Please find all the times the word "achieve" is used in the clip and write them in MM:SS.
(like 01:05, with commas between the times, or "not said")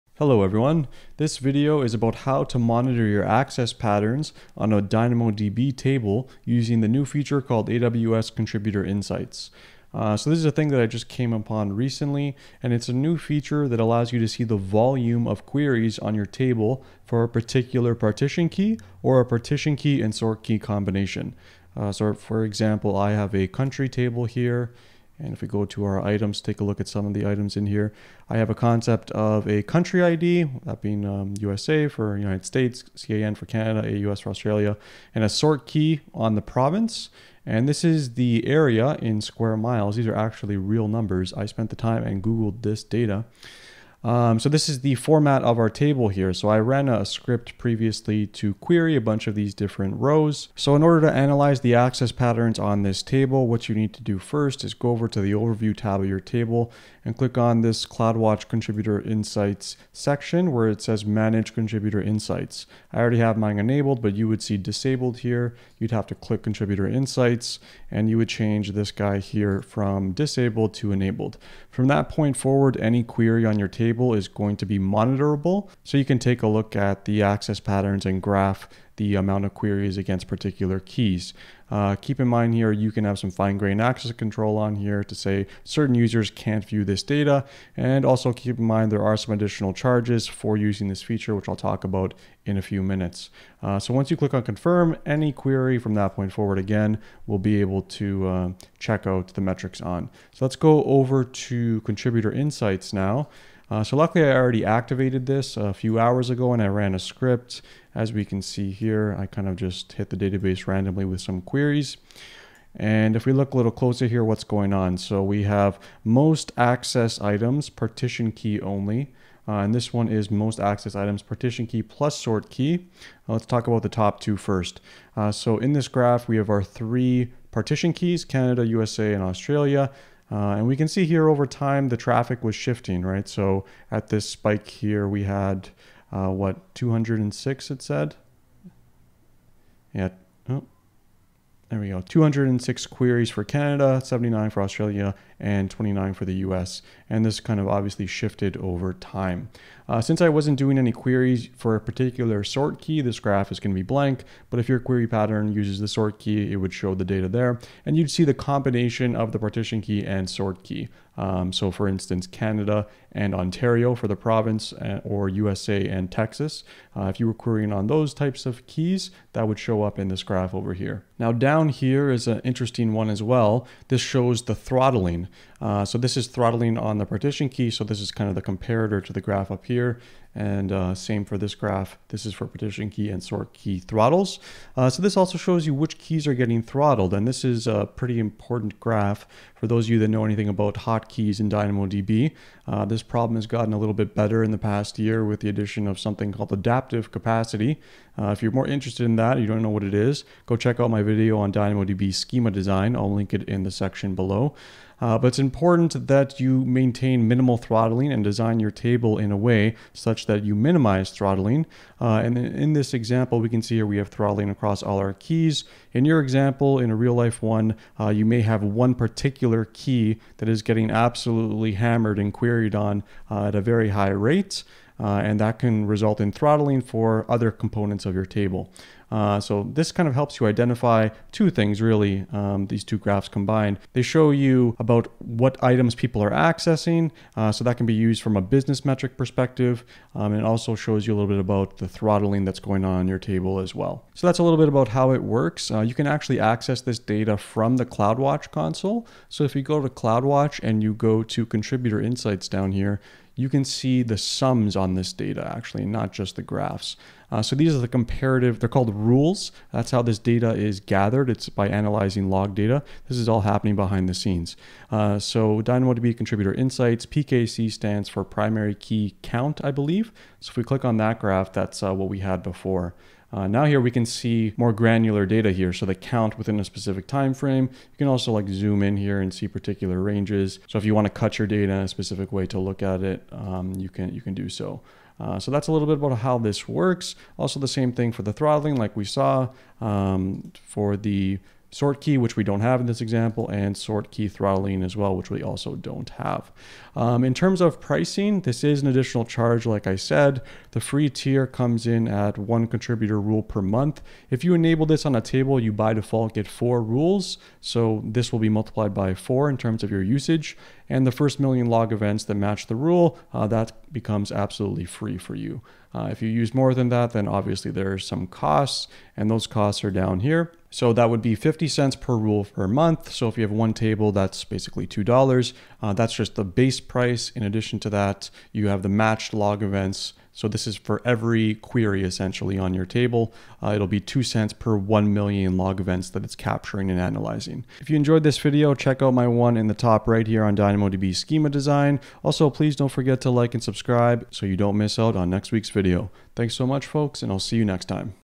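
not said.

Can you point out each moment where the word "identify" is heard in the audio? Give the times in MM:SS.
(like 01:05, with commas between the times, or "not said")
03:50.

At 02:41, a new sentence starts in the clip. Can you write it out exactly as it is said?
Um, so, for instance, Canada and Ontario for the province, uh, or USA and Texas.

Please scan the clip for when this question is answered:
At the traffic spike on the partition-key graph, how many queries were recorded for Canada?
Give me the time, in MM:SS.
02:22.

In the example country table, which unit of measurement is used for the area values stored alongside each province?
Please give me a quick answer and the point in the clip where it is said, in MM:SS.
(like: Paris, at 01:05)
square miles, at 00:39.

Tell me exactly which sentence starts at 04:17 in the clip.
Uh, so these are the comparative, they're called rules.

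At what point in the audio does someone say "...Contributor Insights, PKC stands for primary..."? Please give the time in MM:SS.
04:26.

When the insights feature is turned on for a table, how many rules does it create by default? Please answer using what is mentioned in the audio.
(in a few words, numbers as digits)
4.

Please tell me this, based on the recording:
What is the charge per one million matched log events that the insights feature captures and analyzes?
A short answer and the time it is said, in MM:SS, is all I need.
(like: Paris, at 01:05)
2 cents, at 05:33.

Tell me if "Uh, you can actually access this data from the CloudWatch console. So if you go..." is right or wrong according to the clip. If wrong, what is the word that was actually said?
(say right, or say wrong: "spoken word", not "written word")
right.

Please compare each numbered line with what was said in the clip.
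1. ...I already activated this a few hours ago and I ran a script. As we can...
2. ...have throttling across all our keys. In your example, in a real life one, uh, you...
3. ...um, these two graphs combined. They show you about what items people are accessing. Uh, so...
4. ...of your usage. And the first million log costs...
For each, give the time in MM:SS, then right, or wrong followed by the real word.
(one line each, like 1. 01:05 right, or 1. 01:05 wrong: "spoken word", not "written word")
1. 01:44 right
2. 03:33 right
3. 03:52 right
4. 05:09 wrong: "events", not "costs".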